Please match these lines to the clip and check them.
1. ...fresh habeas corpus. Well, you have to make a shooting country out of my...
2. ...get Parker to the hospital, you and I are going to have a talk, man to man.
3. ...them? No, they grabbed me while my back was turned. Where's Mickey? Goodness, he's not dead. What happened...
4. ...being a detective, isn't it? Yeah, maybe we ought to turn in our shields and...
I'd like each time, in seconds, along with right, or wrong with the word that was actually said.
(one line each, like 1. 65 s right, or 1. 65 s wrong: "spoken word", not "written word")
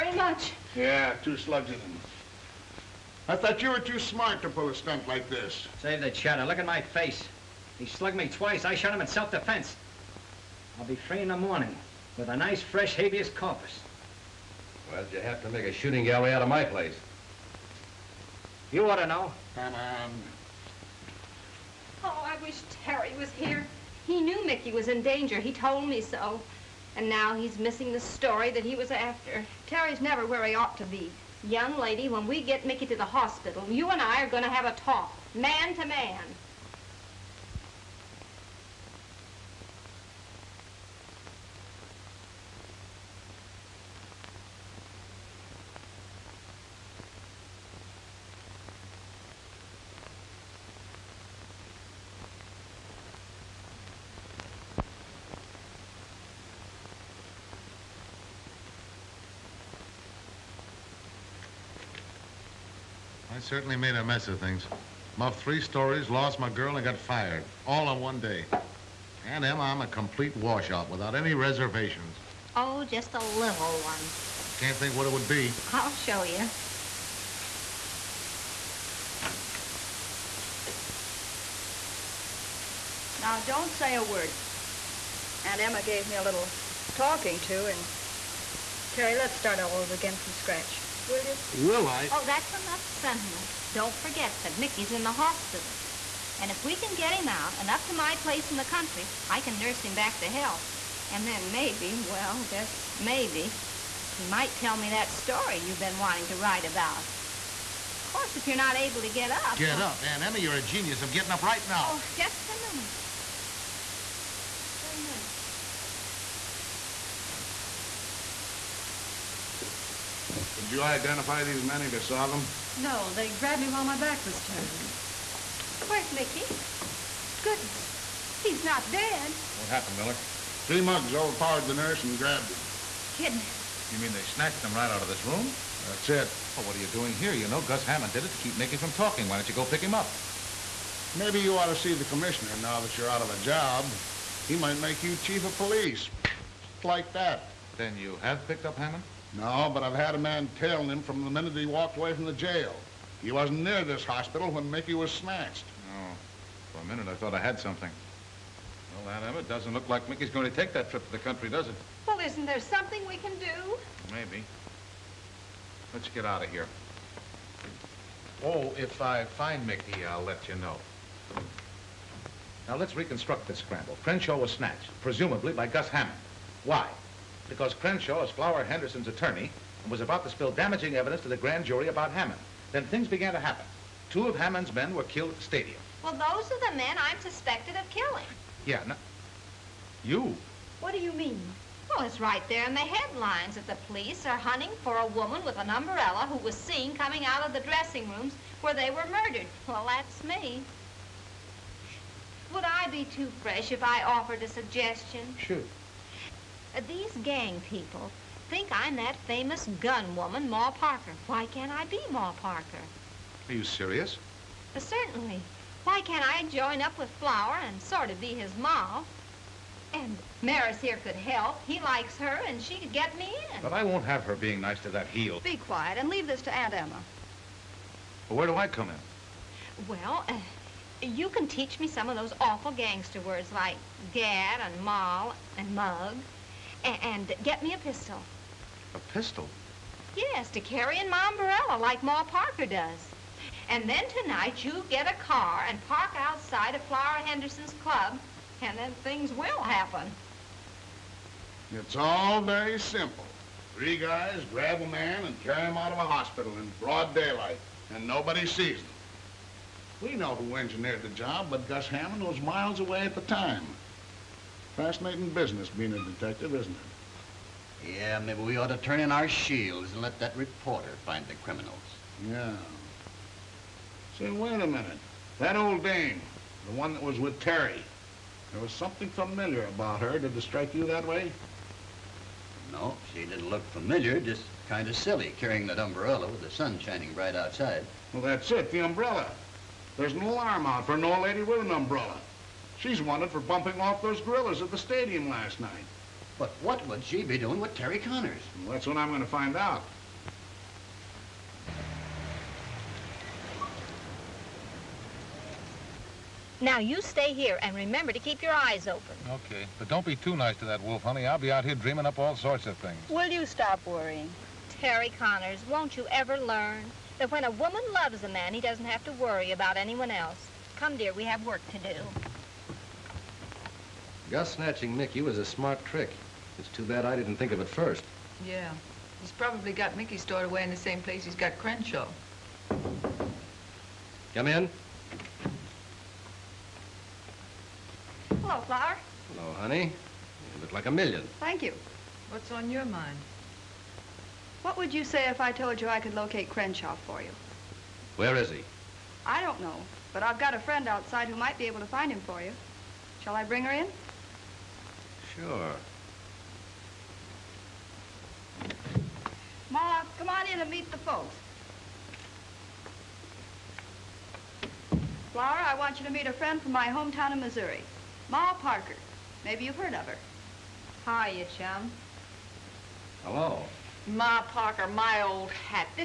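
1. 12 s wrong: "gallery", not "country"
2. 32 s wrong: "Mickey", not "Parker"
3. 122 s right
4. 265 s right.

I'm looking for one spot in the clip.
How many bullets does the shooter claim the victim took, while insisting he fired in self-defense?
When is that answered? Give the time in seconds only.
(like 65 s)
1 s.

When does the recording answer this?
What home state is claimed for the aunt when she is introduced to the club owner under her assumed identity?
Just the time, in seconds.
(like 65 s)
367 s.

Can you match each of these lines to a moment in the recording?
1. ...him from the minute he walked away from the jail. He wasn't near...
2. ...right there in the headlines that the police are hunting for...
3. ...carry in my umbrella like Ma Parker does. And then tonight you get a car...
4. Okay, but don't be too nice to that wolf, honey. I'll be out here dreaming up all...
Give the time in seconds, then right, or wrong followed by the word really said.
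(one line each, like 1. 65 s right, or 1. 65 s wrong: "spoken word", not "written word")
1. 150 s right
2. 192 s right
3. 240 s right
4. 309 s right.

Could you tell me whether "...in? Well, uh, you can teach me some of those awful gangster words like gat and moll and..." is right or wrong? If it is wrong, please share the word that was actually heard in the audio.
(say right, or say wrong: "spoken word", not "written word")
right.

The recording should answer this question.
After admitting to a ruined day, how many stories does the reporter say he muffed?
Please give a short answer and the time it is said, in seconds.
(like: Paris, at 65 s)
3, at 65 s.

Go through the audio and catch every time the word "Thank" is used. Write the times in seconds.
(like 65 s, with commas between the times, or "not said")
341 s.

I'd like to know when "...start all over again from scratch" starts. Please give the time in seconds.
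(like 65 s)
89 s.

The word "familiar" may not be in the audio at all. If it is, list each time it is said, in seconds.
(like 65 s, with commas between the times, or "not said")
279 s, 283 s.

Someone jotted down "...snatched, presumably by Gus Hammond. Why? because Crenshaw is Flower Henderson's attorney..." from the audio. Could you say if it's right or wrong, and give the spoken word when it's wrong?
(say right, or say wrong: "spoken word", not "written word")
right.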